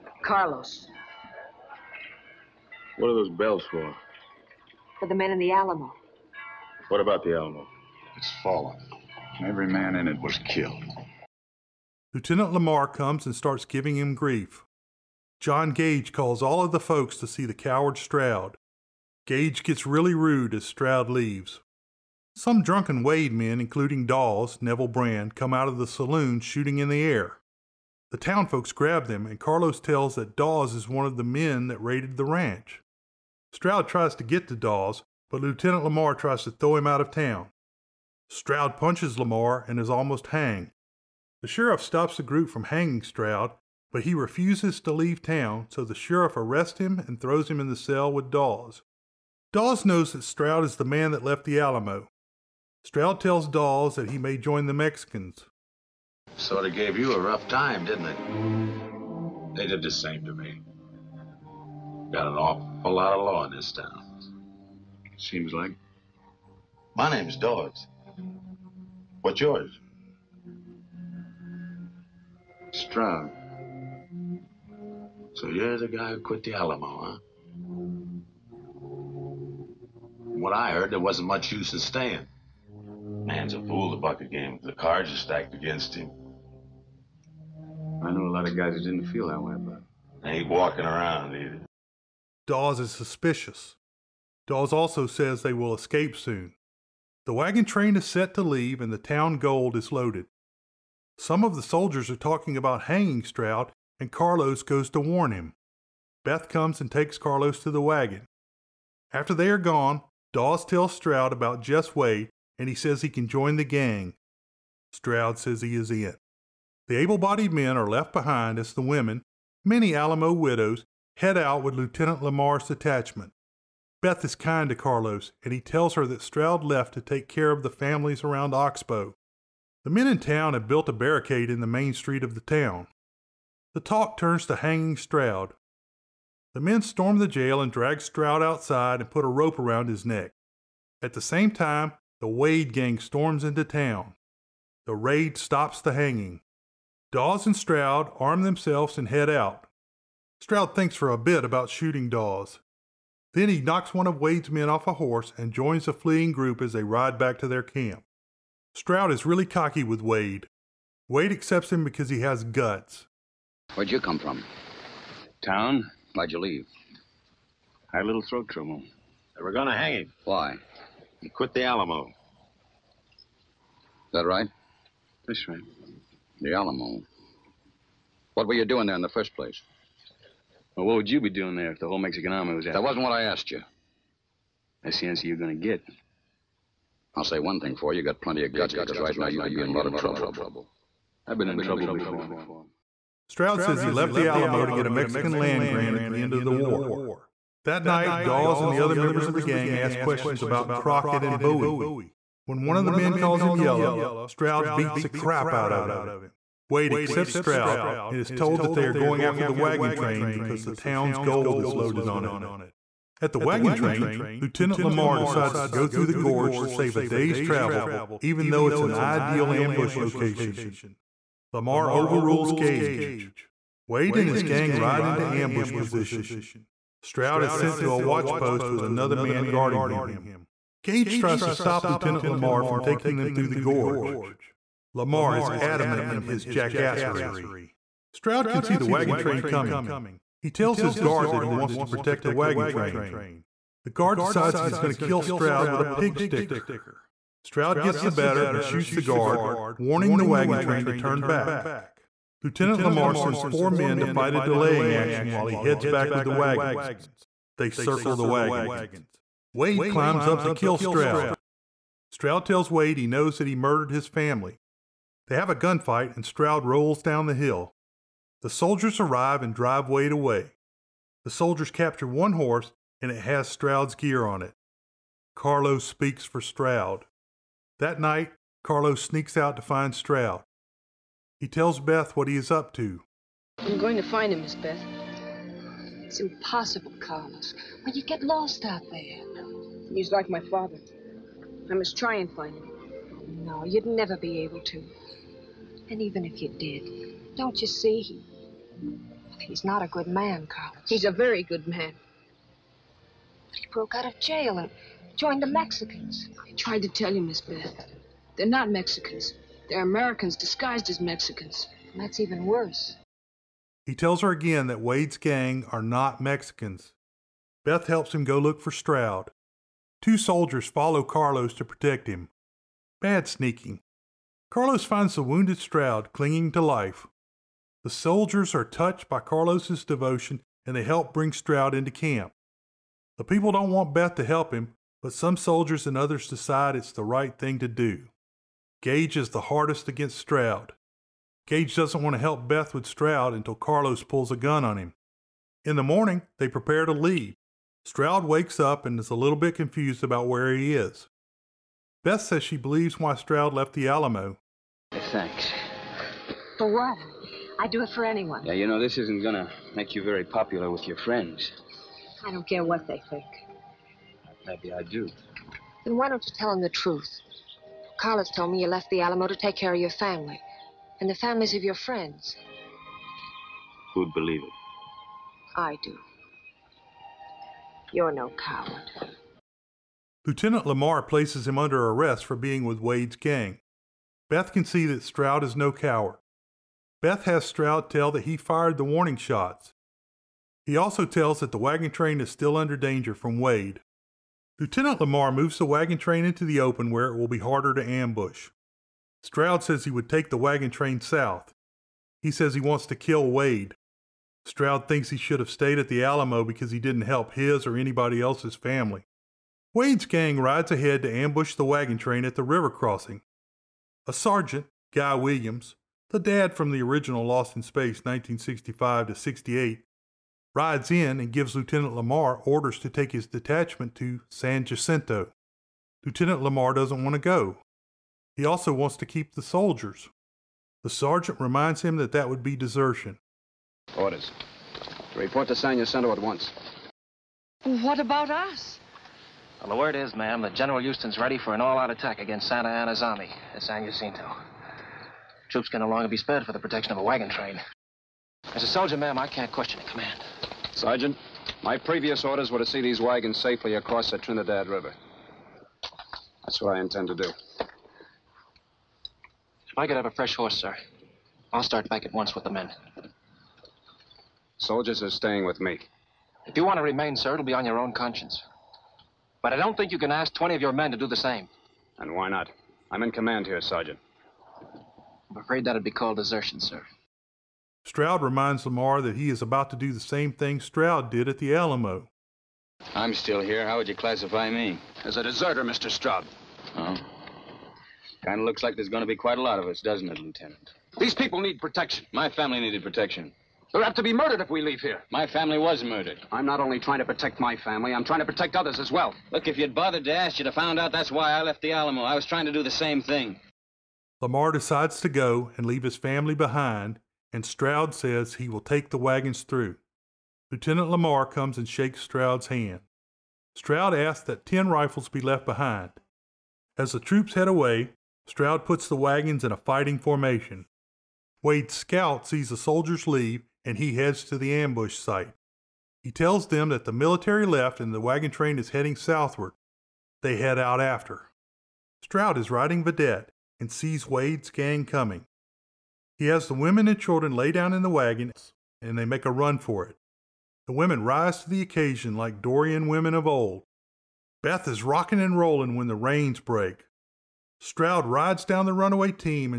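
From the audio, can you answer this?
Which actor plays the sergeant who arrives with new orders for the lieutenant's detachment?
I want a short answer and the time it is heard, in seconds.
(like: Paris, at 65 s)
Guy Williams, at 414 s.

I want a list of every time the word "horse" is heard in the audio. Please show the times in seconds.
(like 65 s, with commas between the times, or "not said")
154 s, 272 s, 460 s.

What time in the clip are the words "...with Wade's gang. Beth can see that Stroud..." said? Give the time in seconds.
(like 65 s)
382 s.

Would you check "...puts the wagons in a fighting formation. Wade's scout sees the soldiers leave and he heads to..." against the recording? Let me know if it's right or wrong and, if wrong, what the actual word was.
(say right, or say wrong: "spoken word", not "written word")
right.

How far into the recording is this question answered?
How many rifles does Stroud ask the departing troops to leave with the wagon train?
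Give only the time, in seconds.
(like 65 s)
514 s.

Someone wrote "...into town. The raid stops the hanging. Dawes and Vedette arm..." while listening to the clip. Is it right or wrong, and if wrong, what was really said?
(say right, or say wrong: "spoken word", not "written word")
wrong: "Stroud", not "Vedette".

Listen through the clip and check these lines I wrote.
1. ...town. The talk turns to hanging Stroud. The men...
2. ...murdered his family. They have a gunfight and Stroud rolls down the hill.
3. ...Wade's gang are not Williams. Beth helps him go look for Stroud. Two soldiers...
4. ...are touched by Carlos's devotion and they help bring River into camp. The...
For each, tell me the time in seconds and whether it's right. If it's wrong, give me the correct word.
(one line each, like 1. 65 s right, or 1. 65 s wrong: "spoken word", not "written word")
1. 132 s right
2. 263 s right
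3. 314 s wrong: "Mexicans", not "Williams"
4. 328 s wrong: "Stroud", not "River".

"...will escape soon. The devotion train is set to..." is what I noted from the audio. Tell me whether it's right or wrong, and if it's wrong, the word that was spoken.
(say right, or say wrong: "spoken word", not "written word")
wrong: "wagon", not "devotion".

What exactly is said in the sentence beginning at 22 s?
Some drunken Wade men, including Dawes, Neville Brand, come out of the saloon shooting in the air.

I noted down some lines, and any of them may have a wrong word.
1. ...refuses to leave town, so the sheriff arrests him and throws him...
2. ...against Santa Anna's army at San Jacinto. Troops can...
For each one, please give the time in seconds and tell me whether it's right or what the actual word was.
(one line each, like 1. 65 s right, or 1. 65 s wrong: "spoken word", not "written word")
1. 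44 s right
2. 442 s right.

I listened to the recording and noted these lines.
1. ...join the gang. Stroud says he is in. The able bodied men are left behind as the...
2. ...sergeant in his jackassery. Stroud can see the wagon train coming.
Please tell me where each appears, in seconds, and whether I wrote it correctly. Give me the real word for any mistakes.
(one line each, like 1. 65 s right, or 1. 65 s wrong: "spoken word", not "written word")
1. 113 s right
2. 235 s wrong: "adamant", not "sergeant".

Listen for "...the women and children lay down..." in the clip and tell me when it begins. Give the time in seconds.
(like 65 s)
536 s.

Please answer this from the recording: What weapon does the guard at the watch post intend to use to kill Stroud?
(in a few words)
A pig sticker.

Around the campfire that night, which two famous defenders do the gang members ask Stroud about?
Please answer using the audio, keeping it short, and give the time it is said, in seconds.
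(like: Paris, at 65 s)
Crockett and Bowie, at 200 s.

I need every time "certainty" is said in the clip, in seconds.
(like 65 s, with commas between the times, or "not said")
not said.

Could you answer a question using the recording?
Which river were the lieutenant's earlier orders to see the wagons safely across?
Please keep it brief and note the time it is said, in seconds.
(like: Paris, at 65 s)
Trinidad River, at 454 s.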